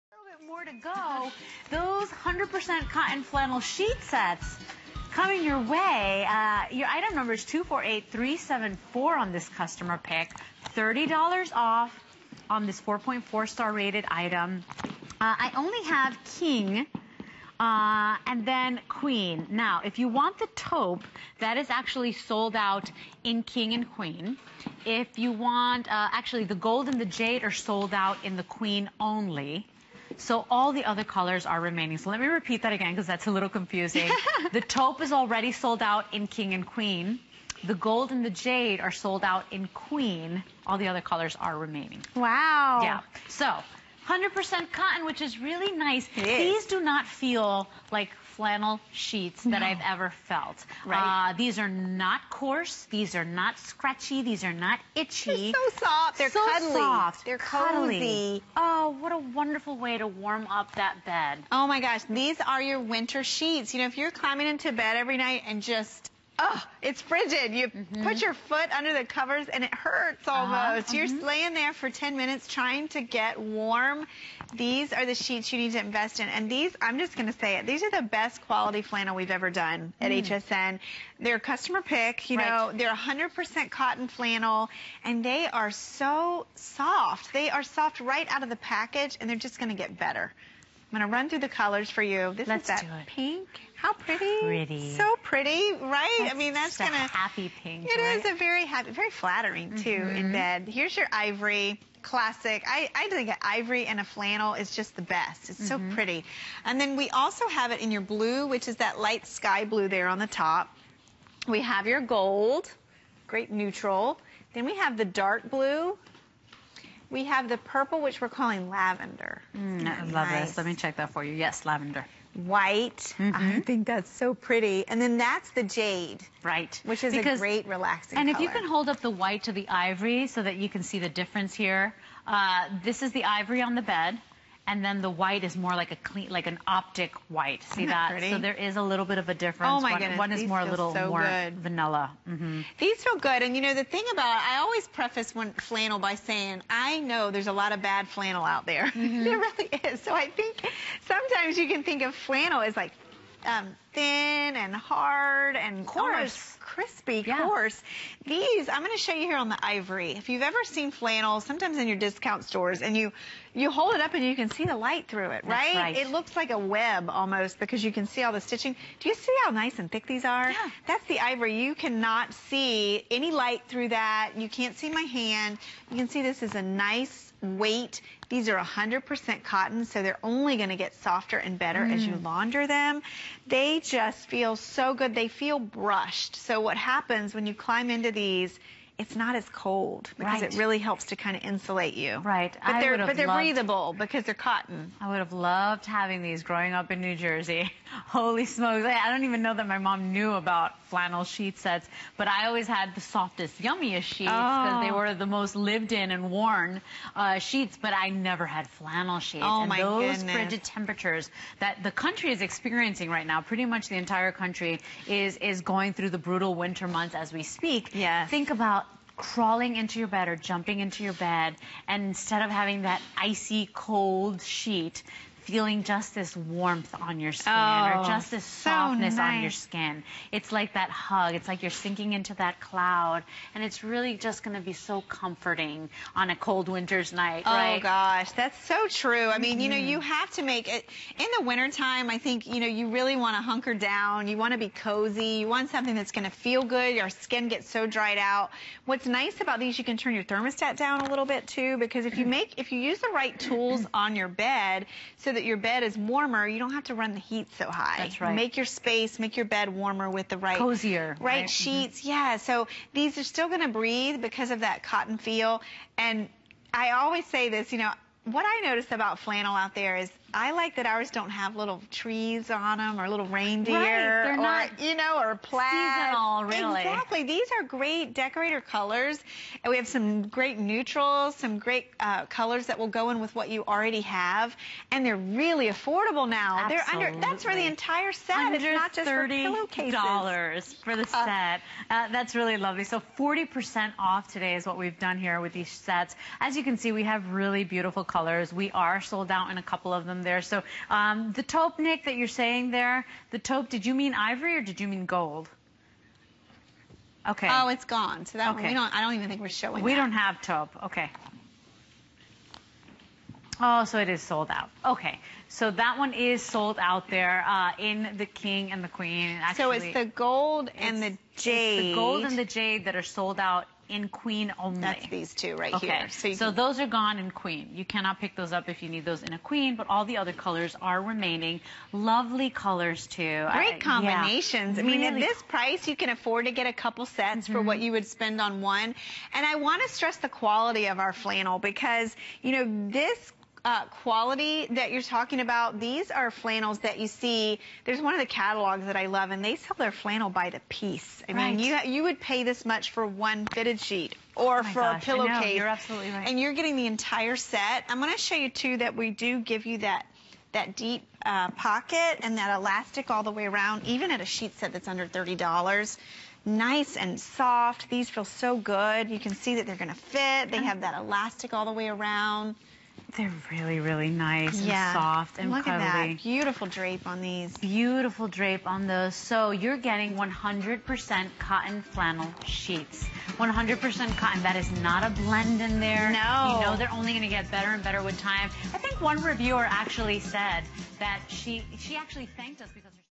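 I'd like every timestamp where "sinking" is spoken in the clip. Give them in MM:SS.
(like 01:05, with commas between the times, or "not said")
03:51.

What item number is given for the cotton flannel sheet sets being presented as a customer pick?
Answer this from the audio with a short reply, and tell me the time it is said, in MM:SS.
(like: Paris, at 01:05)
248374, at 00:07.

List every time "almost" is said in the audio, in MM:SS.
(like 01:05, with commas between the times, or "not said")
01:10, 02:47.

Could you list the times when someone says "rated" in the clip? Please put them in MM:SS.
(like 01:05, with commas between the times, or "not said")
00:13.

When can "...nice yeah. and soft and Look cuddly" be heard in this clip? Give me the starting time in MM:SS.
06:14.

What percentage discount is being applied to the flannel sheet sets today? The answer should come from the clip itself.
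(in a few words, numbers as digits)
40%.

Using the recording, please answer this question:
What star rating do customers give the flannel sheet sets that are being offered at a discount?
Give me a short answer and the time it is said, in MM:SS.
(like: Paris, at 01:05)
4.4, at 00:12.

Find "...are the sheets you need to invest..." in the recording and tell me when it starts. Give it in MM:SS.
01:14.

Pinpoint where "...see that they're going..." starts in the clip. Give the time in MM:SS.
06:09.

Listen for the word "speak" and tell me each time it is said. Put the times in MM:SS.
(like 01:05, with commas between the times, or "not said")
03:37.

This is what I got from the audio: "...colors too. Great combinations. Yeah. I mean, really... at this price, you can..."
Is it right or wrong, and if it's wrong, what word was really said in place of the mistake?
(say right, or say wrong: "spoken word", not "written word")
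right.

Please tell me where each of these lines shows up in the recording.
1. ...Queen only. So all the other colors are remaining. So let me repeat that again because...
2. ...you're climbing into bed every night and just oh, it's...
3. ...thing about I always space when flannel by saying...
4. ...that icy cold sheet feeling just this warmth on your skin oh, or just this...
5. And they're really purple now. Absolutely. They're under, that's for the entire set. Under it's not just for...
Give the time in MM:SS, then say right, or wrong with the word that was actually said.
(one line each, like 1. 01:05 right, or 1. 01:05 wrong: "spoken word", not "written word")
1. 00:28 right
2. 01:03 right
3. 02:23 wrong: "preface", not "space"
4. 03:42 right
5. 04:44 wrong: "affordable", not "purple".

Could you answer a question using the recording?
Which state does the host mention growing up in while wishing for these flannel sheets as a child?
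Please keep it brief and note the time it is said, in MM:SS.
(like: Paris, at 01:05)
New Jersey, at 03:17.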